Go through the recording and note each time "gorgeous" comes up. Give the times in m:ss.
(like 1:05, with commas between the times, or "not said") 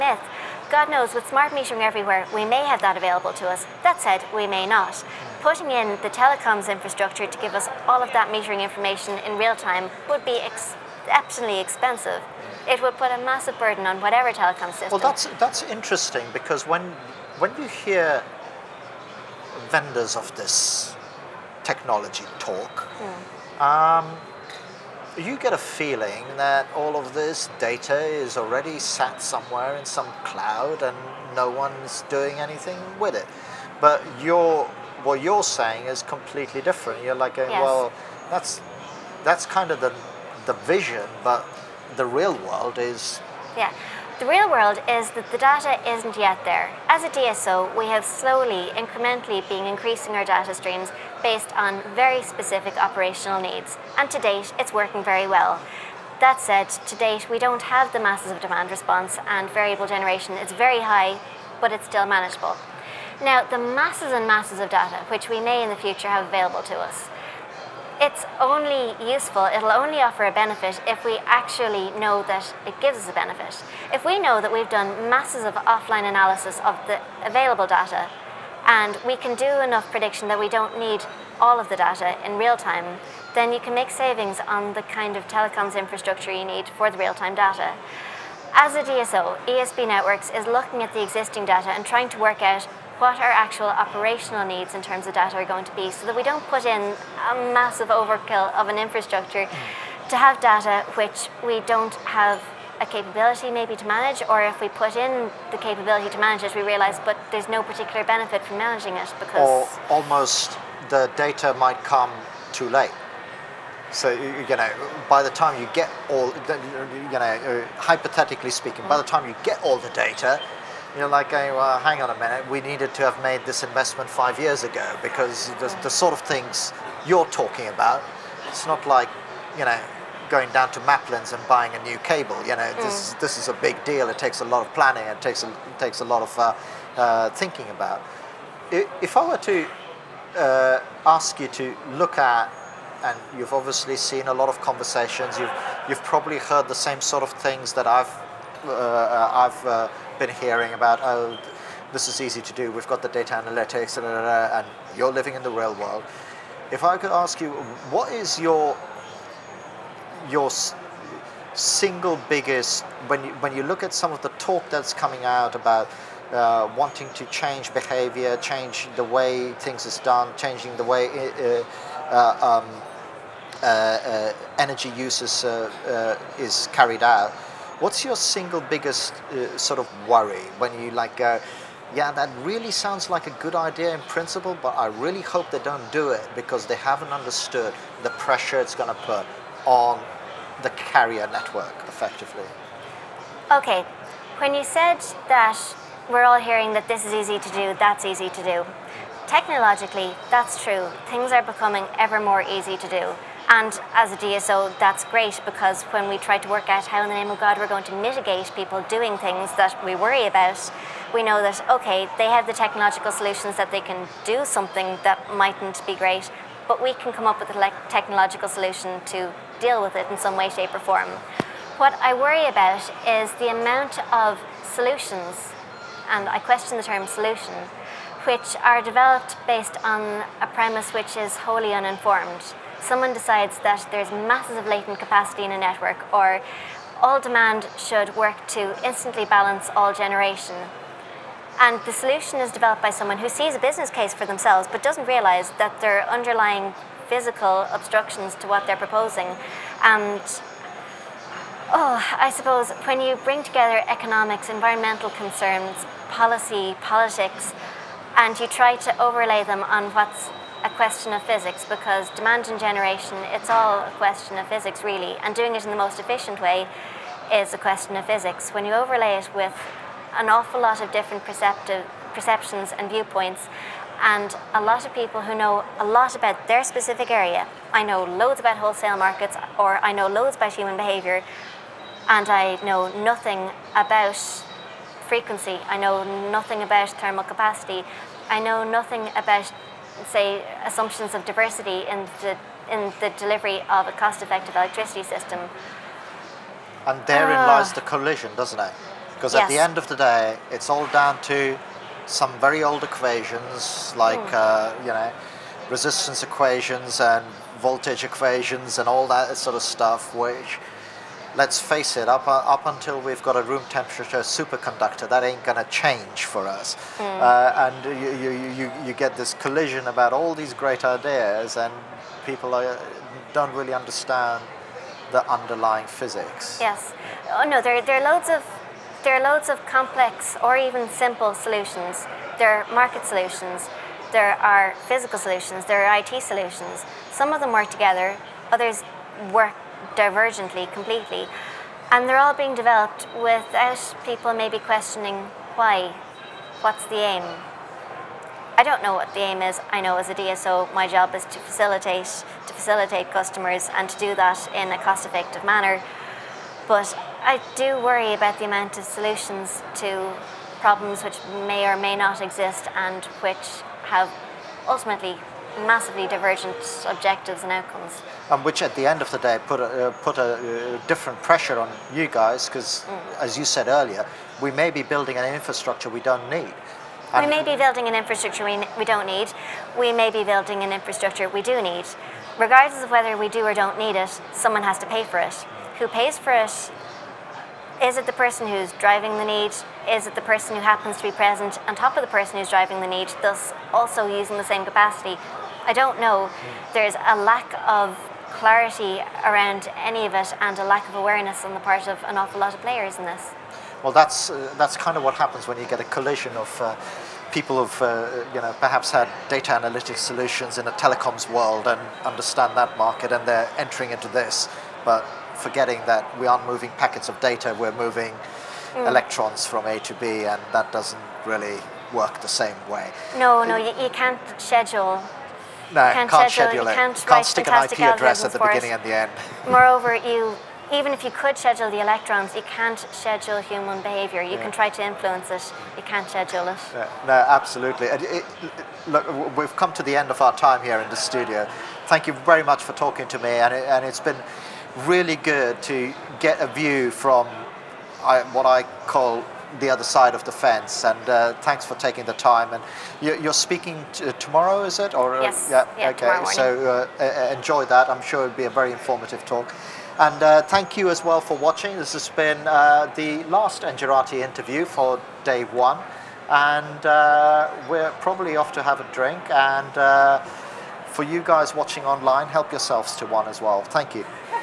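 not said.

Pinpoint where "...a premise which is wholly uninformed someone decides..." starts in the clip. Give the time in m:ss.
3:50.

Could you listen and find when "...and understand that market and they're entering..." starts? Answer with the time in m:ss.
6:51.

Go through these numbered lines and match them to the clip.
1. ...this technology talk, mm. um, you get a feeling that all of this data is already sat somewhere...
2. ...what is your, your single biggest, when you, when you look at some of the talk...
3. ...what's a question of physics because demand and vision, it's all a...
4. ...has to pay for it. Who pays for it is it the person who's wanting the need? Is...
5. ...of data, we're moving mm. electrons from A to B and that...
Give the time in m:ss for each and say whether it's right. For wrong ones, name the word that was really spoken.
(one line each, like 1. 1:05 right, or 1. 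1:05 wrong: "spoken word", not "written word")
1. 0:20 right
2. 2:37 right
3. 4:19 wrong: "generation", not "vision"
4. 6:24 wrong: "driving", not "wanting"
5. 6:57 right.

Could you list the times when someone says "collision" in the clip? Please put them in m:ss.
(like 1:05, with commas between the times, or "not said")
4:57, 5:19, 6:45.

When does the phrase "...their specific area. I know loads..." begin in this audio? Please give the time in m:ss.
4:36.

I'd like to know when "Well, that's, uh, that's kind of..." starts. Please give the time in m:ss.
6:43.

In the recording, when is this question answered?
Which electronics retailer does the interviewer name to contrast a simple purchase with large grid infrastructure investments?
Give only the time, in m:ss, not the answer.
2:10.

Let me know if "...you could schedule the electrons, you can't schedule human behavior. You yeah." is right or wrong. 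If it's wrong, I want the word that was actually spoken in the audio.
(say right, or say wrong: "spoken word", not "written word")
right.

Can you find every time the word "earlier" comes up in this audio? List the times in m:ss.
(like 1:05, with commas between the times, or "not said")
6:13.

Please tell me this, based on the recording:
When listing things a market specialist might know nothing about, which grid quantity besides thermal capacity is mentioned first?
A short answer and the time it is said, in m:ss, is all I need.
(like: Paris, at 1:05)
frequency, at 4:45.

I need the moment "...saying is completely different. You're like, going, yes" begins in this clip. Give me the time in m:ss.
0:35.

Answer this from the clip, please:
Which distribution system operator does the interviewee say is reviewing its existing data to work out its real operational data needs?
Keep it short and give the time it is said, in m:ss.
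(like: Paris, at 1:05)
ESB Networks, at 1:29.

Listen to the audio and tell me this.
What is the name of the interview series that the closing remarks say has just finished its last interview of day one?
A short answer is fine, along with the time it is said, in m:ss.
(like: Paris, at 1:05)
Engerati, at 7:43.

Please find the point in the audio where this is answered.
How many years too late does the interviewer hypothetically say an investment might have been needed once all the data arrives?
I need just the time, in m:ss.
2:04.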